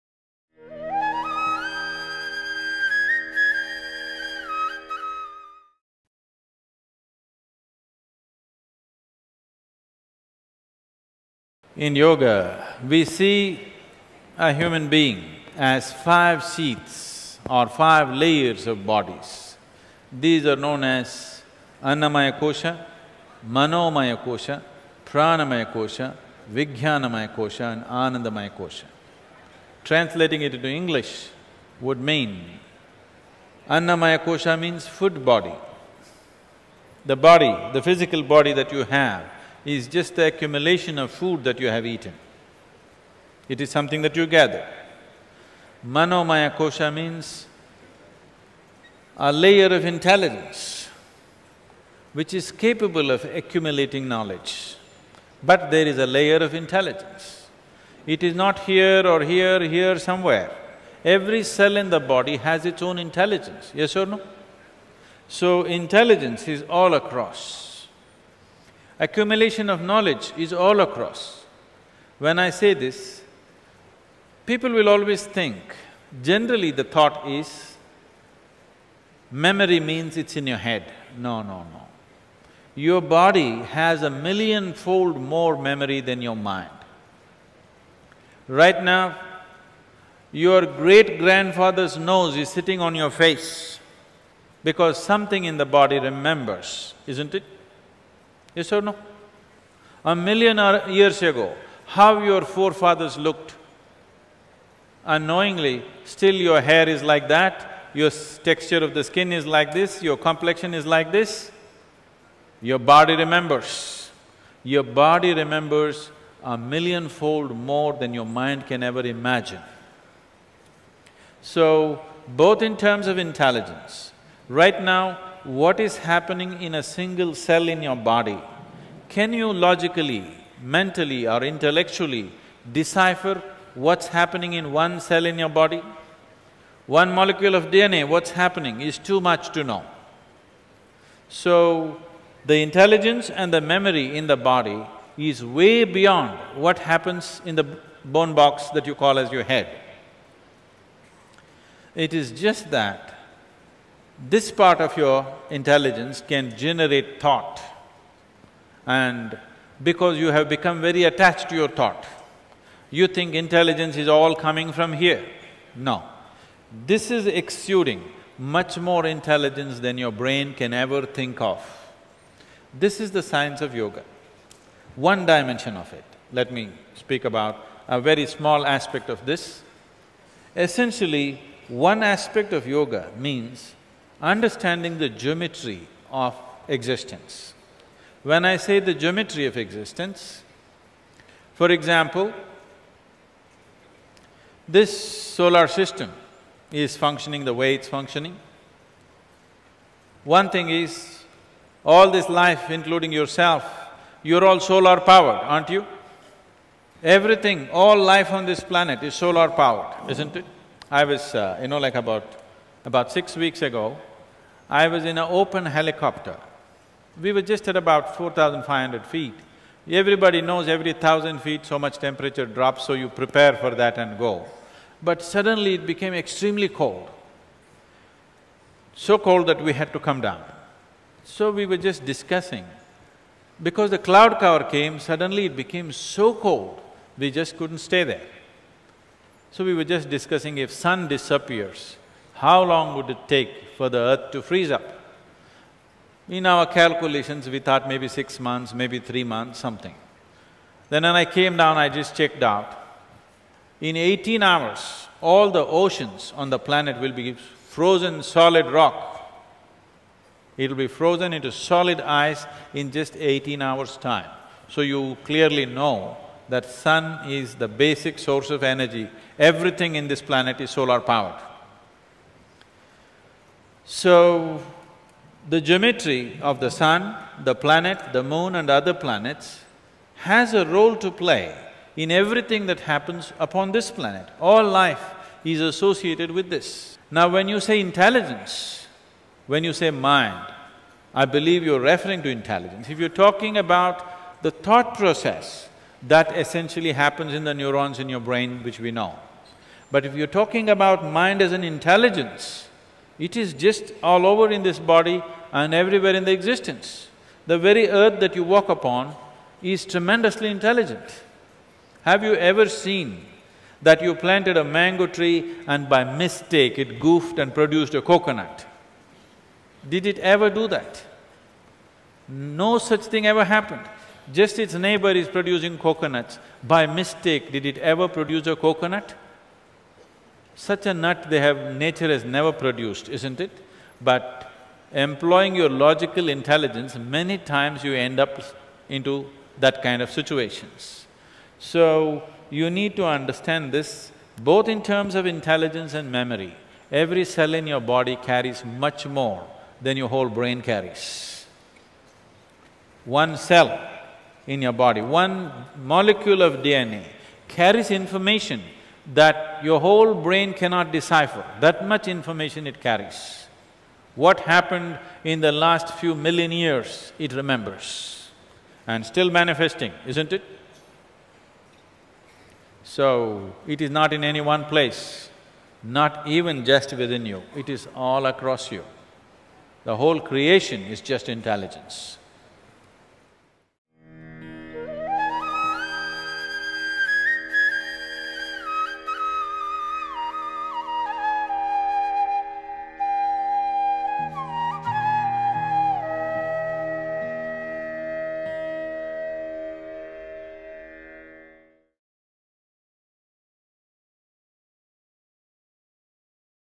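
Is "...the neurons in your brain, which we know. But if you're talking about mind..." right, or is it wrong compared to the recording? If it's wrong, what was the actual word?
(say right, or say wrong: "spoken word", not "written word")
right.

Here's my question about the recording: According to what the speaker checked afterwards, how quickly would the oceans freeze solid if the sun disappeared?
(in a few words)
18 hours.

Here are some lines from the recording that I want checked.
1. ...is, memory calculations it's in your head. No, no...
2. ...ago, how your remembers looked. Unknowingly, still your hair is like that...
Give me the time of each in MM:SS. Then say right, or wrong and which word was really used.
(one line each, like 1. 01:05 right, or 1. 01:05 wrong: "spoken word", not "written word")
1. 01:17 wrong: "means", not "calculations"
2. 01:41 wrong: "forefathers", not "remembers".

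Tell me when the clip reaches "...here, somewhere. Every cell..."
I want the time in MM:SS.
00:59.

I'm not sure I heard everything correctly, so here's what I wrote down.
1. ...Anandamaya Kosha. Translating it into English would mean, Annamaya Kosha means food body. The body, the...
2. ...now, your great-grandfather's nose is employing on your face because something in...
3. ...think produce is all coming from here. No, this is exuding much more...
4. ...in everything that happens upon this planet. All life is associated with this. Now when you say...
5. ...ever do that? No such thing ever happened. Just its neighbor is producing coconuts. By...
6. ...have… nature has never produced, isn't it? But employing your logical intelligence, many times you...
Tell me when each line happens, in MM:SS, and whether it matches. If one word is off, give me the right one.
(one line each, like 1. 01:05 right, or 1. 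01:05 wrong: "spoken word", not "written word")
1. 00:27 right
2. 01:28 wrong: "sitting", not "employing"
3. 02:43 wrong: "intelligence", not "produce"
4. 04:41 right
5. 05:20 right
6. 05:31 right.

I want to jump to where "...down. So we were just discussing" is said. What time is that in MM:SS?
03:50.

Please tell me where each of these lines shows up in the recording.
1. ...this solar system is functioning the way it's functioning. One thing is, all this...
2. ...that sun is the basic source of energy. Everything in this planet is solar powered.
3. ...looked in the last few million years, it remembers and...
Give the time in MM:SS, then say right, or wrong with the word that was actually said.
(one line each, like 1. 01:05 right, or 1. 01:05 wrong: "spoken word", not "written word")
1. 03:14 right
2. 04:26 right
3. 06:04 wrong: "happened", not "looked".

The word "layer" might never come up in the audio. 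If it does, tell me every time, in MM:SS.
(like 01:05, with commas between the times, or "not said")
00:18, 00:49, 00:56.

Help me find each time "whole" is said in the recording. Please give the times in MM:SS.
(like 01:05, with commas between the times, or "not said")
05:50, 05:59, 06:19.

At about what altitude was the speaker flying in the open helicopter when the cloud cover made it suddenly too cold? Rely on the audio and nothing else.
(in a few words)
4,500 feet.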